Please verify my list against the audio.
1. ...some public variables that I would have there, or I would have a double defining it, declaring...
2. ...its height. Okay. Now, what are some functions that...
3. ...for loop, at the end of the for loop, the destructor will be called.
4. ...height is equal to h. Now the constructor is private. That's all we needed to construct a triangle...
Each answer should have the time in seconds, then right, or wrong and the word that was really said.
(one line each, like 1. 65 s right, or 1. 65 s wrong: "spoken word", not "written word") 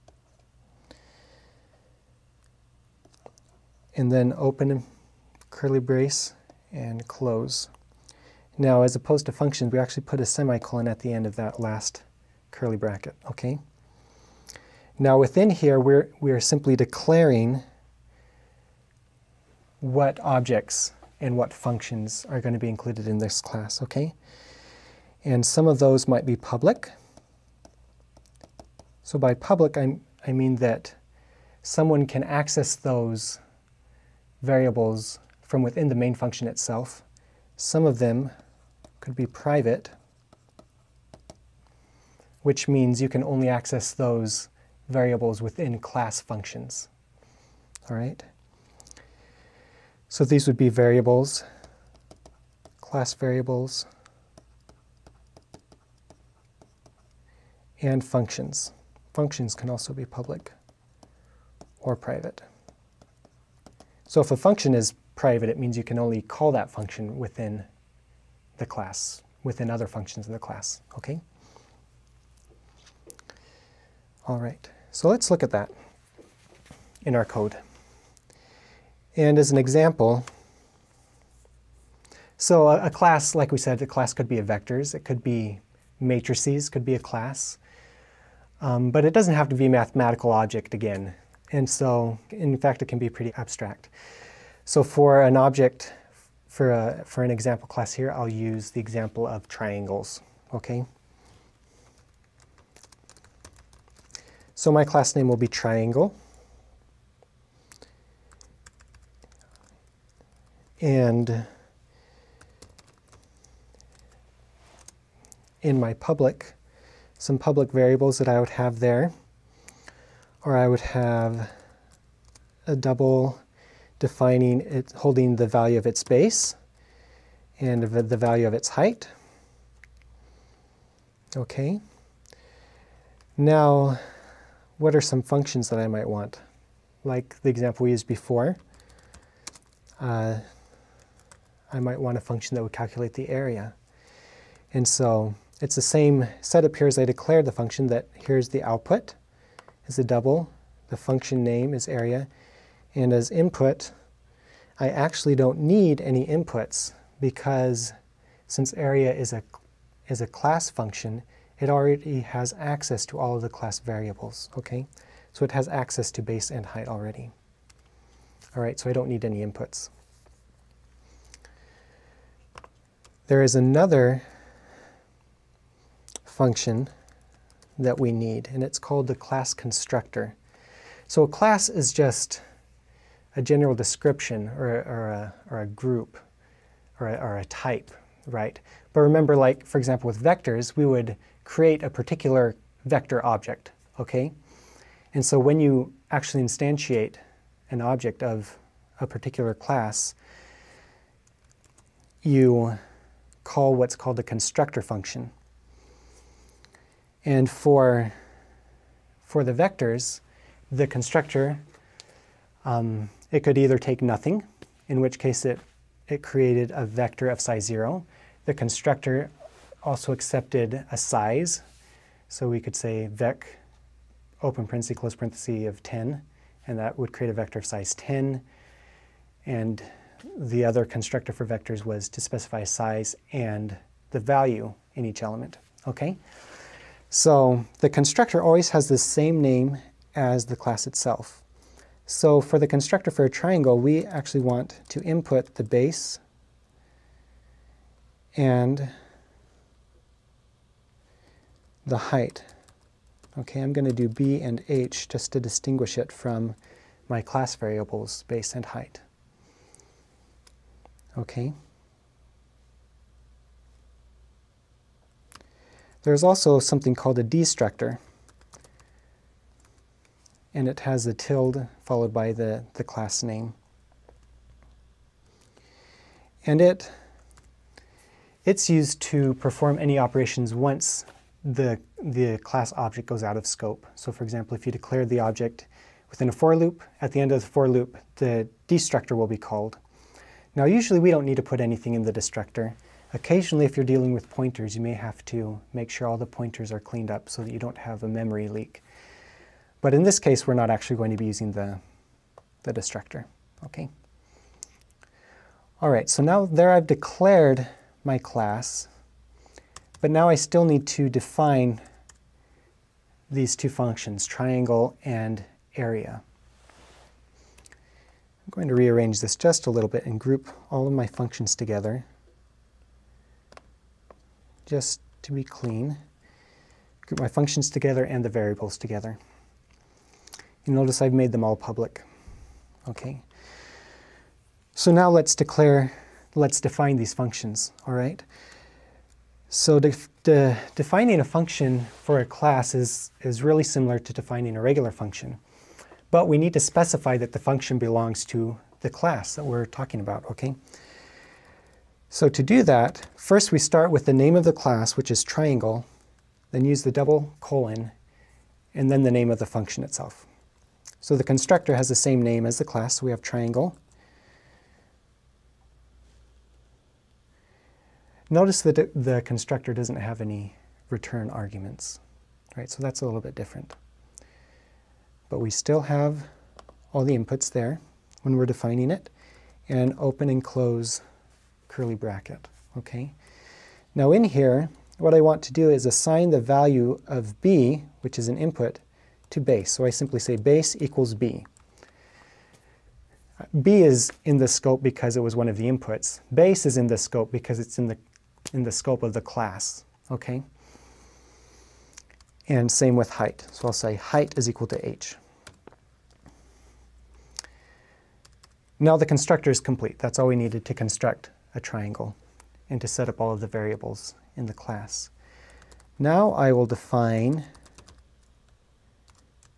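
1. 117 s wrong: "holding", not "declaring"
2. 128 s right
3. 286 s right
4. 403 s wrong: "complete", not "private".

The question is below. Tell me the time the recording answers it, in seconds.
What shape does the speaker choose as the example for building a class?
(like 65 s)
99 s.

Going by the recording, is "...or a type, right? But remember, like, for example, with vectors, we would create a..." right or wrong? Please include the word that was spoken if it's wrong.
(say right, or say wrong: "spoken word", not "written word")
right.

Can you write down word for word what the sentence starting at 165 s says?
So it has access to base and height already.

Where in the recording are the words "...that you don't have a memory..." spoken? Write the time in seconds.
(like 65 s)
297 s.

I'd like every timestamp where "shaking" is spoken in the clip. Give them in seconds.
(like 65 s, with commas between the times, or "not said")
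not said.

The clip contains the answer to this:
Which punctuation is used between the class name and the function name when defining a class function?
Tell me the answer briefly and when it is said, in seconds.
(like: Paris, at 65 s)
double colon, at 356 s.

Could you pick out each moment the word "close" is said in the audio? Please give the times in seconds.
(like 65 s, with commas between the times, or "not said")
7 s, 224 s, 380 s.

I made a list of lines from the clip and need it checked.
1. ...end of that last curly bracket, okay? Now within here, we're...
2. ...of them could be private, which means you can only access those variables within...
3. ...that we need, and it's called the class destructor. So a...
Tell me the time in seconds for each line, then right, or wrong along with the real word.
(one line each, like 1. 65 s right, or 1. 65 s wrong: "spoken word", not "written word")
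1. 11 s right
2. 37 s right
3. 177 s wrong: "constructor", not "destructor".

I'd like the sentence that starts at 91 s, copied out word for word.
And so, in fact, it can be pretty abstract.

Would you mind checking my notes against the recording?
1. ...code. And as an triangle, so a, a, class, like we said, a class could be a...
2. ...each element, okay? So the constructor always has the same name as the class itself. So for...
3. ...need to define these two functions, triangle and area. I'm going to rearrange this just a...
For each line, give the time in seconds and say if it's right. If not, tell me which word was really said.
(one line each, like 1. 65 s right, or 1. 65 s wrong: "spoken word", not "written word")
1. 77 s wrong: "example", not "triangle"
2. 235 s right
3. 310 s right.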